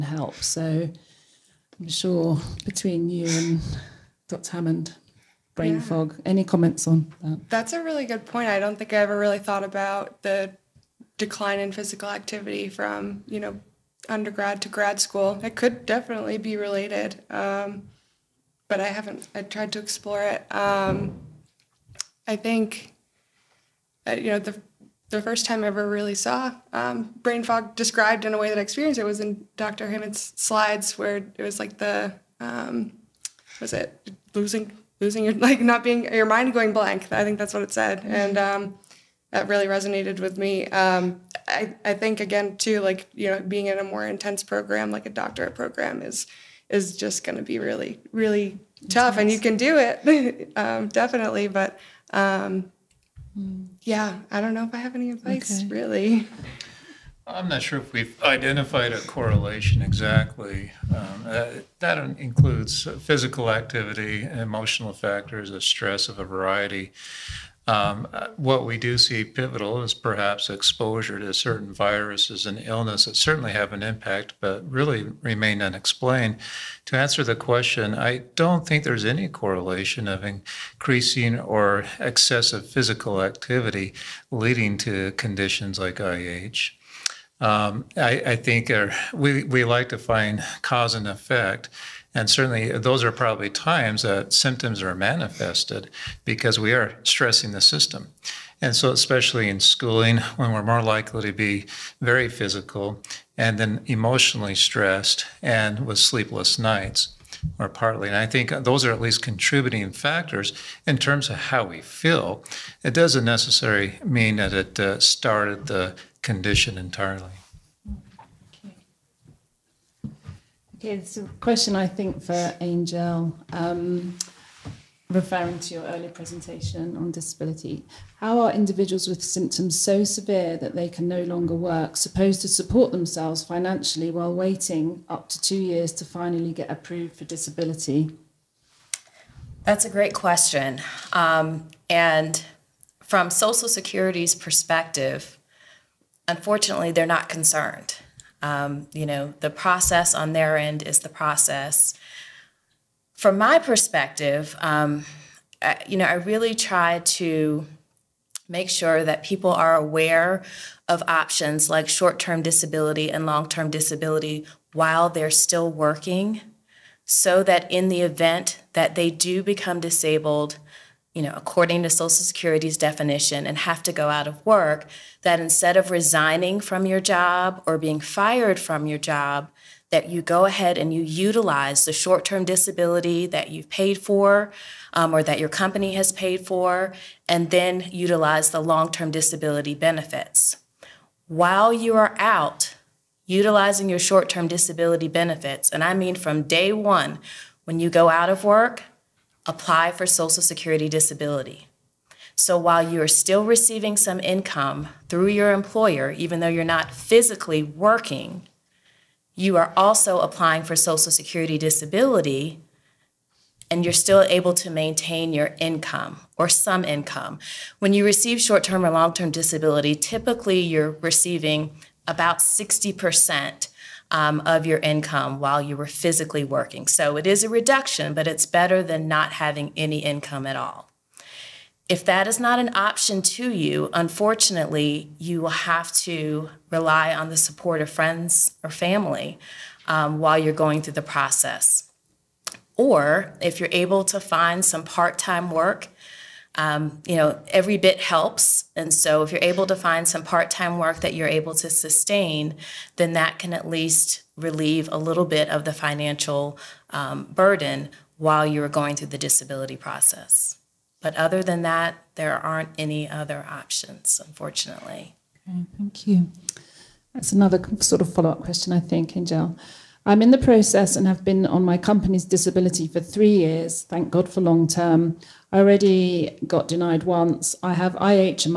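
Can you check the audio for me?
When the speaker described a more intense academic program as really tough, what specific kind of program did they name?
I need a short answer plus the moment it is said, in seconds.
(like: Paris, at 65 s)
doctorate program, at 45 s.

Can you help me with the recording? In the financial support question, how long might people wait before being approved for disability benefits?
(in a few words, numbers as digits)
2 years.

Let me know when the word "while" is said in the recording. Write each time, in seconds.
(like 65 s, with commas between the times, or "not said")
134 s, 164 s, 191 s, 202 s, 225 s, 240 s, 258 s.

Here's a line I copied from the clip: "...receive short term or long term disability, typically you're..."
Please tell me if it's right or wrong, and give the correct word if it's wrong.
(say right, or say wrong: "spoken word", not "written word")
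right.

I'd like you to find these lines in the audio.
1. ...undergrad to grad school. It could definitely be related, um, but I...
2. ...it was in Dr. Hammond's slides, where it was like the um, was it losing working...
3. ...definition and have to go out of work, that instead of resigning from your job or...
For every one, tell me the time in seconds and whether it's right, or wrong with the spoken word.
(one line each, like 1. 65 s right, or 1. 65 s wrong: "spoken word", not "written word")
1. 14 s right
2. 28 s wrong: "losing", not "working"
3. 172 s right.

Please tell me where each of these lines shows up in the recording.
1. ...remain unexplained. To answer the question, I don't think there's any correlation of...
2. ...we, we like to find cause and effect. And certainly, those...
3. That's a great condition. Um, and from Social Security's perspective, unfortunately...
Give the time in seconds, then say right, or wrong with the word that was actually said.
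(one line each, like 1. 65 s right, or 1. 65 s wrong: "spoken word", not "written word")
1. 75 s right
2. 89 s right
3. 139 s wrong: "question", not "condition".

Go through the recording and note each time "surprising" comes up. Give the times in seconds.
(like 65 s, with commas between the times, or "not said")
not said.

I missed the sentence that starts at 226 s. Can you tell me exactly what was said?
So it is a reduction, but it's better than not having any income at all.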